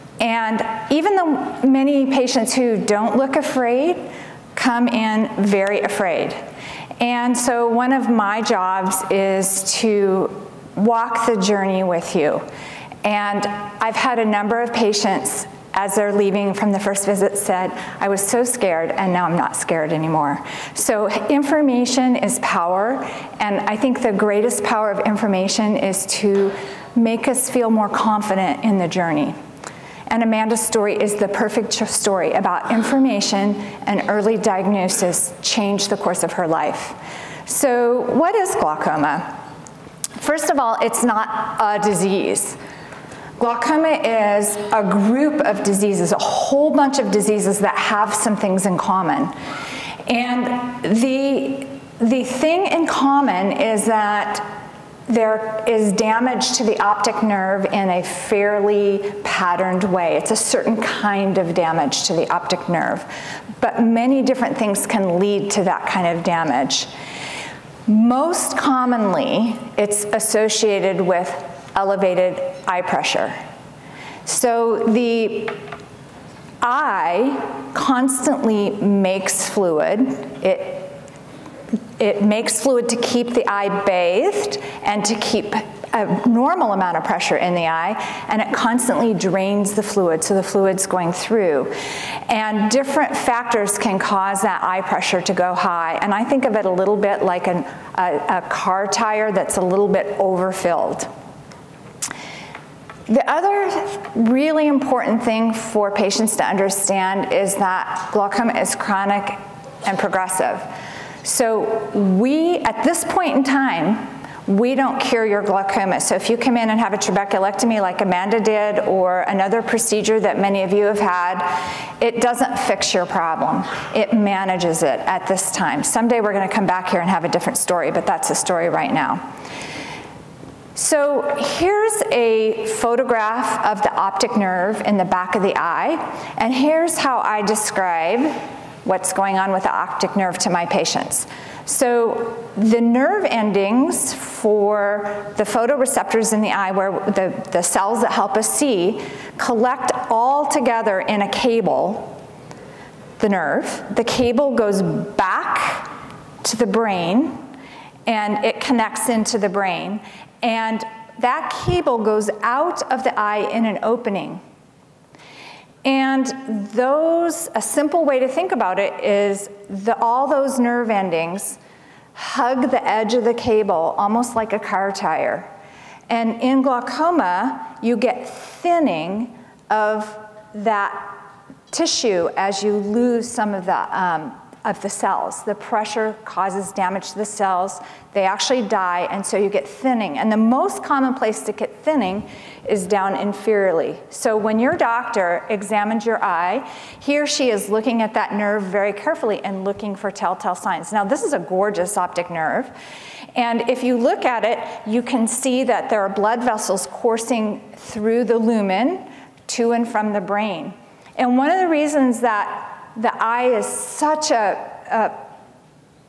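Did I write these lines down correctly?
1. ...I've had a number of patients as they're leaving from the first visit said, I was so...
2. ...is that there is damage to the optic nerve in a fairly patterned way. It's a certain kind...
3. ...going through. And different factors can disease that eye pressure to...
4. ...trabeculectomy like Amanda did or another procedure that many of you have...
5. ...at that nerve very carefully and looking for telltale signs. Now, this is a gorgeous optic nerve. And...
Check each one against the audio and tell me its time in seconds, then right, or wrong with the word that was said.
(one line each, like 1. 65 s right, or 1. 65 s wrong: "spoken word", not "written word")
1. 13 s right
2. 53 s right
3. 90 s wrong: "cause", not "disease"
4. 116 s right
5. 198 s right.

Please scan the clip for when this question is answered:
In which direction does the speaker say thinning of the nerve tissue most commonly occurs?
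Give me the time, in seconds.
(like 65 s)
193 s.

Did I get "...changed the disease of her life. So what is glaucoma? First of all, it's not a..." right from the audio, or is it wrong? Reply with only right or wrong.
wrong.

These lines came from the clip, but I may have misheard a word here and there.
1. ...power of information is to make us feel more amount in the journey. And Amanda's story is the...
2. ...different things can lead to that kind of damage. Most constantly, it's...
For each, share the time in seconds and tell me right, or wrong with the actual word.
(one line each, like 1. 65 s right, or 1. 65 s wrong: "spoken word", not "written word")
1. 24 s wrong: "confident", not "amount"
2. 64 s wrong: "commonly", not "constantly".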